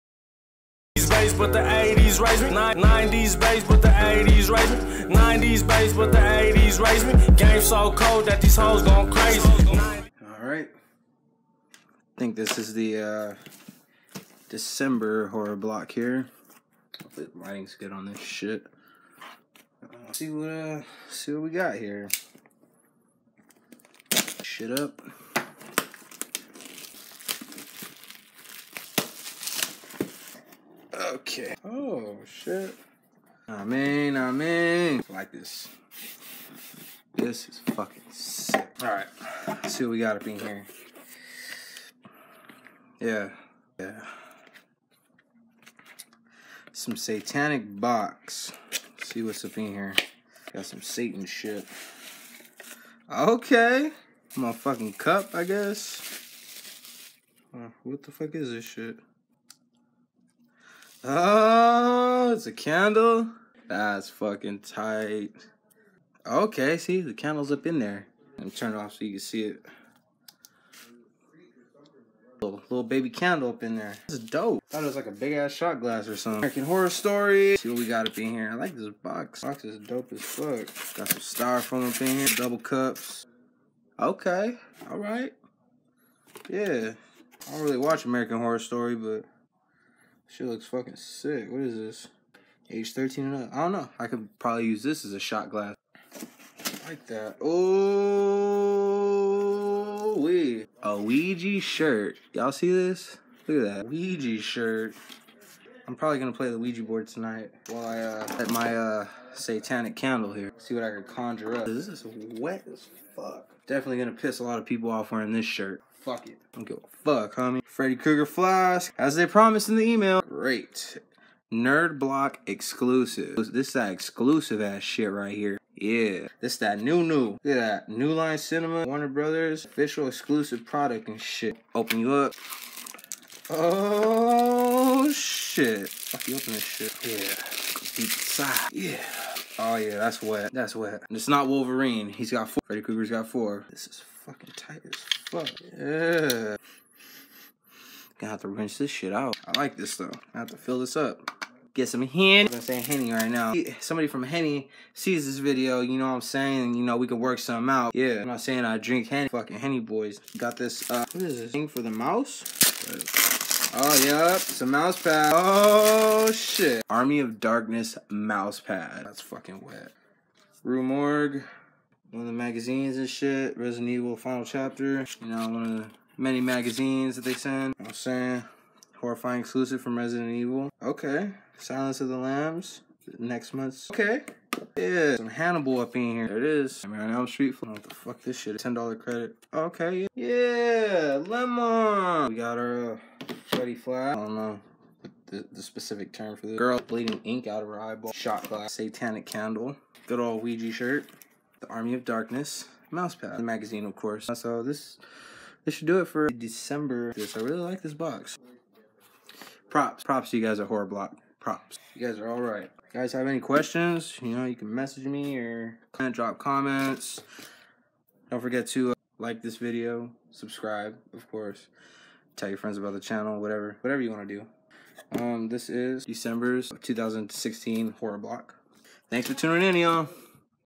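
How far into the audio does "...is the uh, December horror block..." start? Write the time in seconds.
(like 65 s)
12 s.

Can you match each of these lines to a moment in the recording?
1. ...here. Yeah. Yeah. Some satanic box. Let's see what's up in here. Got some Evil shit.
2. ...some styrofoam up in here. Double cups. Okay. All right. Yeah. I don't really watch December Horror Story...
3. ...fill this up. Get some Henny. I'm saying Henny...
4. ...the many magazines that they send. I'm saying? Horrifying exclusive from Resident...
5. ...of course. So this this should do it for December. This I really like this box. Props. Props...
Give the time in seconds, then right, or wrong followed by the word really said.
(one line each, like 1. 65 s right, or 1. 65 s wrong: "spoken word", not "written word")
1. 40 s wrong: "Satan", not "Evil"
2. 81 s wrong: "American", not "December"
3. 150 s right
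4. 175 s right
5. 203 s right.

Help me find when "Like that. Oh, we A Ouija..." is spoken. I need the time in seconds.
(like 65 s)
96 s.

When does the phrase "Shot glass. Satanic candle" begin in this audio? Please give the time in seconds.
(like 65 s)
198 s.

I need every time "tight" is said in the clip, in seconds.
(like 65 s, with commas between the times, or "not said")
64 s, 144 s.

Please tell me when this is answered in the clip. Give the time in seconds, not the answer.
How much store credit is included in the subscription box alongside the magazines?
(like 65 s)
188 s.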